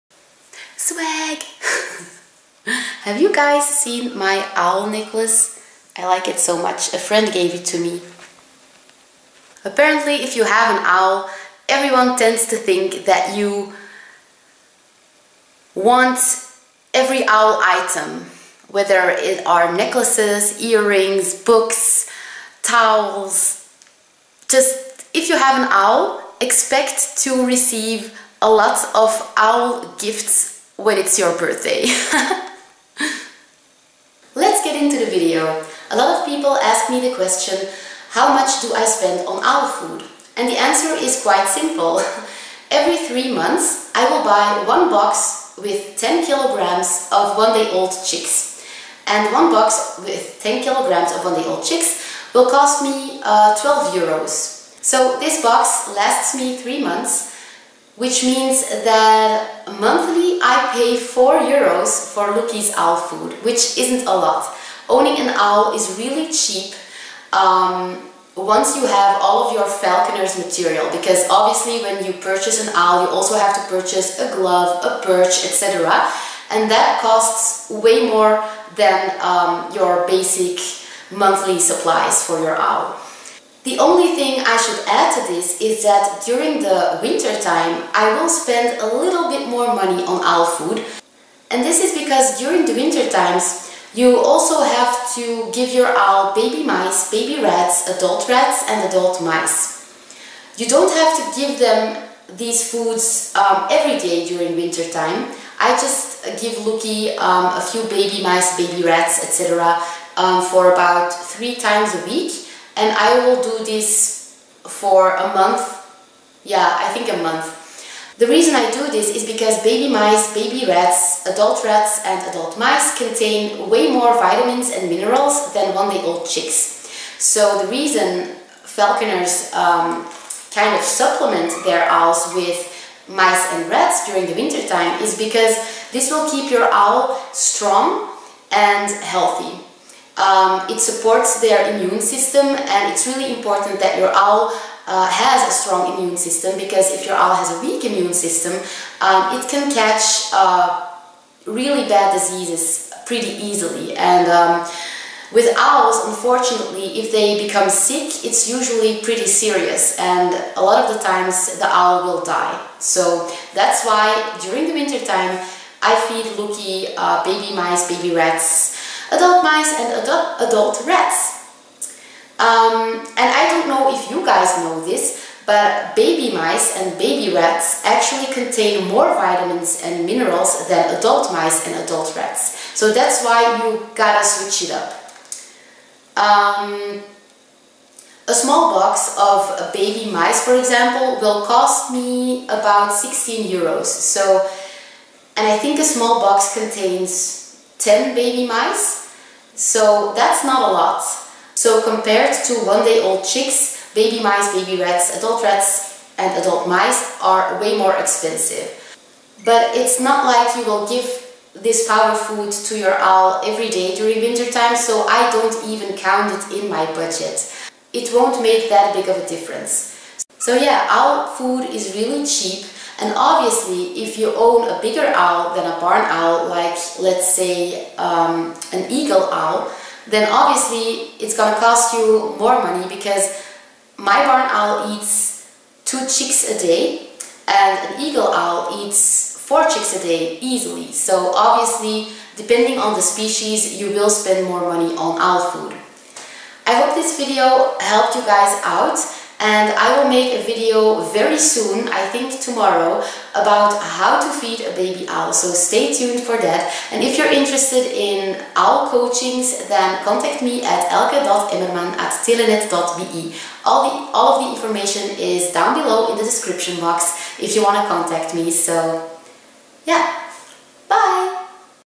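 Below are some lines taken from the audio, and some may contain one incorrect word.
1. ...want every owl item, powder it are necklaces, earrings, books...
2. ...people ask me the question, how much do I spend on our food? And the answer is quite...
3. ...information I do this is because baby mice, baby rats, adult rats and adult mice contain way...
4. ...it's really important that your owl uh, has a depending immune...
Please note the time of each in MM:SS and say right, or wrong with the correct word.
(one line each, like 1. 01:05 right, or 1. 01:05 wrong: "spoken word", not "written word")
1. 00:15 wrong: "whether", not "powder"
2. 00:36 right
3. 01:58 wrong: "reason", not "information"
4. 02:22 wrong: "strong", not "depending".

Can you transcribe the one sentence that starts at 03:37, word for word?
It won't make that big of a difference.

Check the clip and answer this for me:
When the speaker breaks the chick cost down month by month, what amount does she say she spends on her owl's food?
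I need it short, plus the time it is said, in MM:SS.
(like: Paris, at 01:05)
4 euros, at 01:00.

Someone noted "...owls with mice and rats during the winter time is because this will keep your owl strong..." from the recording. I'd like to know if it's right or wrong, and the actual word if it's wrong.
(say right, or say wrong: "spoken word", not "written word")
right.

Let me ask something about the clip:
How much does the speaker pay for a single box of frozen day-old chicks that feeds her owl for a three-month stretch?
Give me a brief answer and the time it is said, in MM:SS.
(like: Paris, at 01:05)
12 euros, at 00:53.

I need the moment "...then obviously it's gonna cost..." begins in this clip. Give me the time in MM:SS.
03:50.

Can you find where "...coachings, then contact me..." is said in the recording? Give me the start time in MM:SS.
04:18.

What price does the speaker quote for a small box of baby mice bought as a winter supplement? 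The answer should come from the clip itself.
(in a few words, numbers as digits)
16 euros.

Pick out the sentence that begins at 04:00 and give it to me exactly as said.
So obviously, depending on the species, you will spend more money on owl food.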